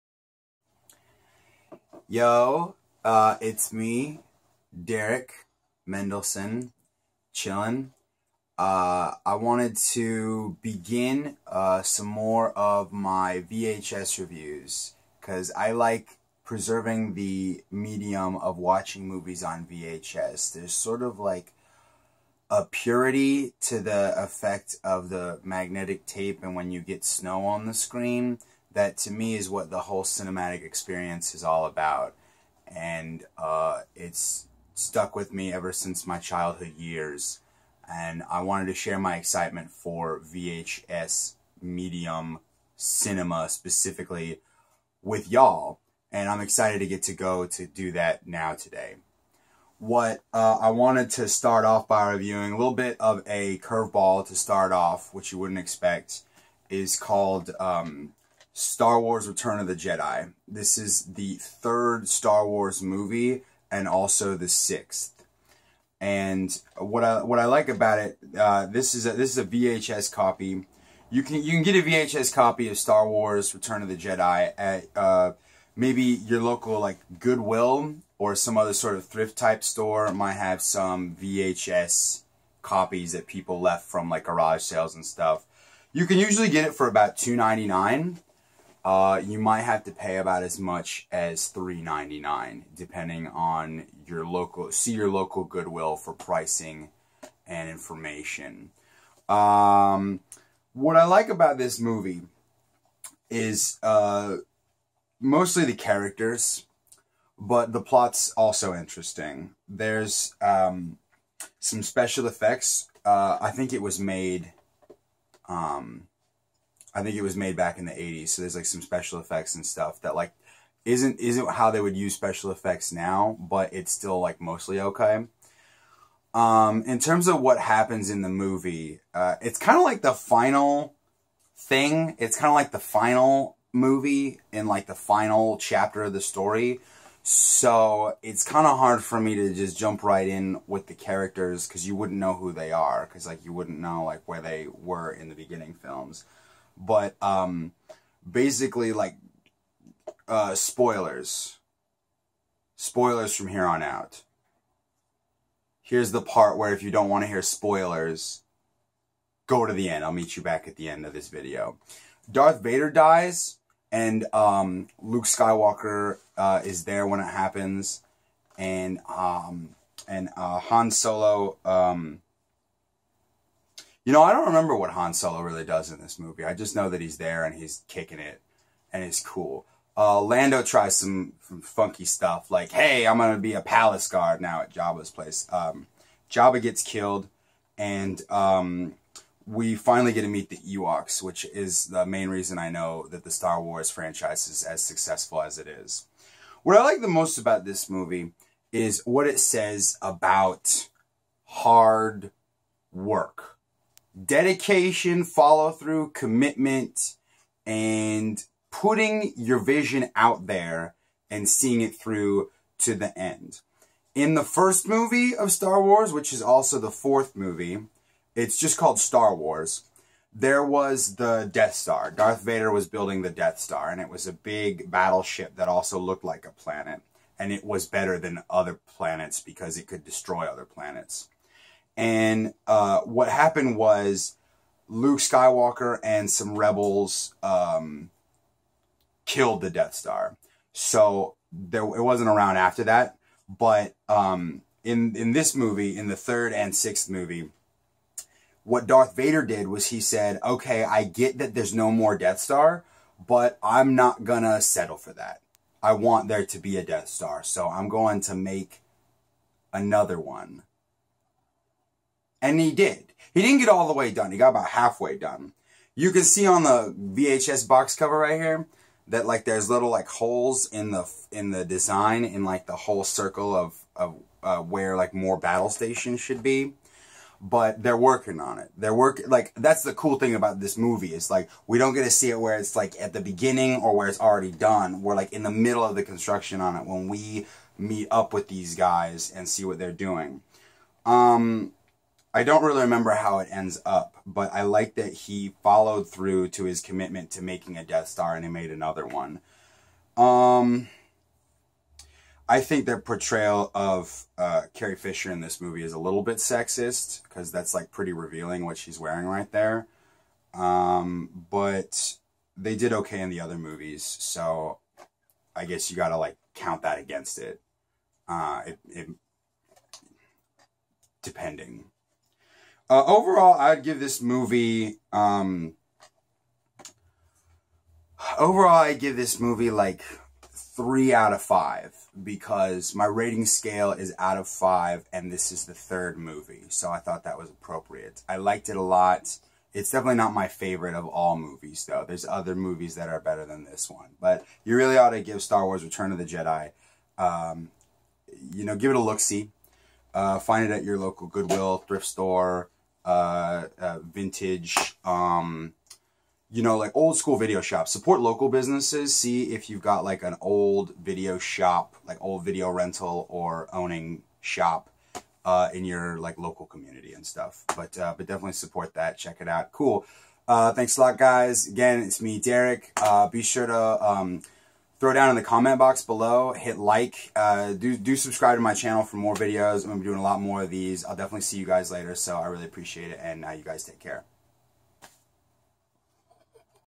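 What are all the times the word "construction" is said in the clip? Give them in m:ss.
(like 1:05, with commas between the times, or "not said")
4:46.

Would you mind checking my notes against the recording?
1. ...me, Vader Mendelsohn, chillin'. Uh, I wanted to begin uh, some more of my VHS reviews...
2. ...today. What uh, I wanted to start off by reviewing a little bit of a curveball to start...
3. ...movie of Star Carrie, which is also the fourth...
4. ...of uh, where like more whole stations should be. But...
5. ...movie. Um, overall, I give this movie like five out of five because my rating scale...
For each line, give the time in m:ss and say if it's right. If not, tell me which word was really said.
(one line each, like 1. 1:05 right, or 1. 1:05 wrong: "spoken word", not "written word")
1. 0:03 wrong: "Derick", not "Vader"
2. 0:48 right
3. 3:34 wrong: "Wars", not "Carrie"
4. 4:33 wrong: "battle", not "whole"
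5. 5:24 wrong: "three", not "five".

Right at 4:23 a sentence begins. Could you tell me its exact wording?
He didn't get all the way done.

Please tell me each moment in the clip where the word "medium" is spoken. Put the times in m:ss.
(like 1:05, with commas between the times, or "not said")
0:17, 0:41.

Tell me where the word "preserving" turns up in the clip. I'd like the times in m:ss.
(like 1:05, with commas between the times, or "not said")
0:16.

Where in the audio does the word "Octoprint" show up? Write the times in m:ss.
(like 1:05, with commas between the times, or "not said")
not said.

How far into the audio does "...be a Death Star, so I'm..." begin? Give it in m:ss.
4:16.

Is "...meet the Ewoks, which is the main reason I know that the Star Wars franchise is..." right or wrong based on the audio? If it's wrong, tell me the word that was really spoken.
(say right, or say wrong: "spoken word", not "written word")
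right.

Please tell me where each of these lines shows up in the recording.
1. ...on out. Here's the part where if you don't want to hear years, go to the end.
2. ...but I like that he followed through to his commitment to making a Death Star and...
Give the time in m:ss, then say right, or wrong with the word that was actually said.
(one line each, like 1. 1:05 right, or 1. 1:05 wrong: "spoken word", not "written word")
1. 2:33 wrong: "spoilers", not "years"
2. 4:54 right.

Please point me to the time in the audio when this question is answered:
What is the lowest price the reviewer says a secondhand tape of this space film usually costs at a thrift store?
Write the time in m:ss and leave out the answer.
1:27.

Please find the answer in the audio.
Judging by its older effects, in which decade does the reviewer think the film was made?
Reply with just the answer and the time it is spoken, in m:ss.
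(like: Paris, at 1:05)
the 80s, at 1:57.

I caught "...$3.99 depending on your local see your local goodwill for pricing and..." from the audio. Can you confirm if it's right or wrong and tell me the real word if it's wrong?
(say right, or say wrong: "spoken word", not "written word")
right.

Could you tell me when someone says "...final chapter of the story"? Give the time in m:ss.
2:14.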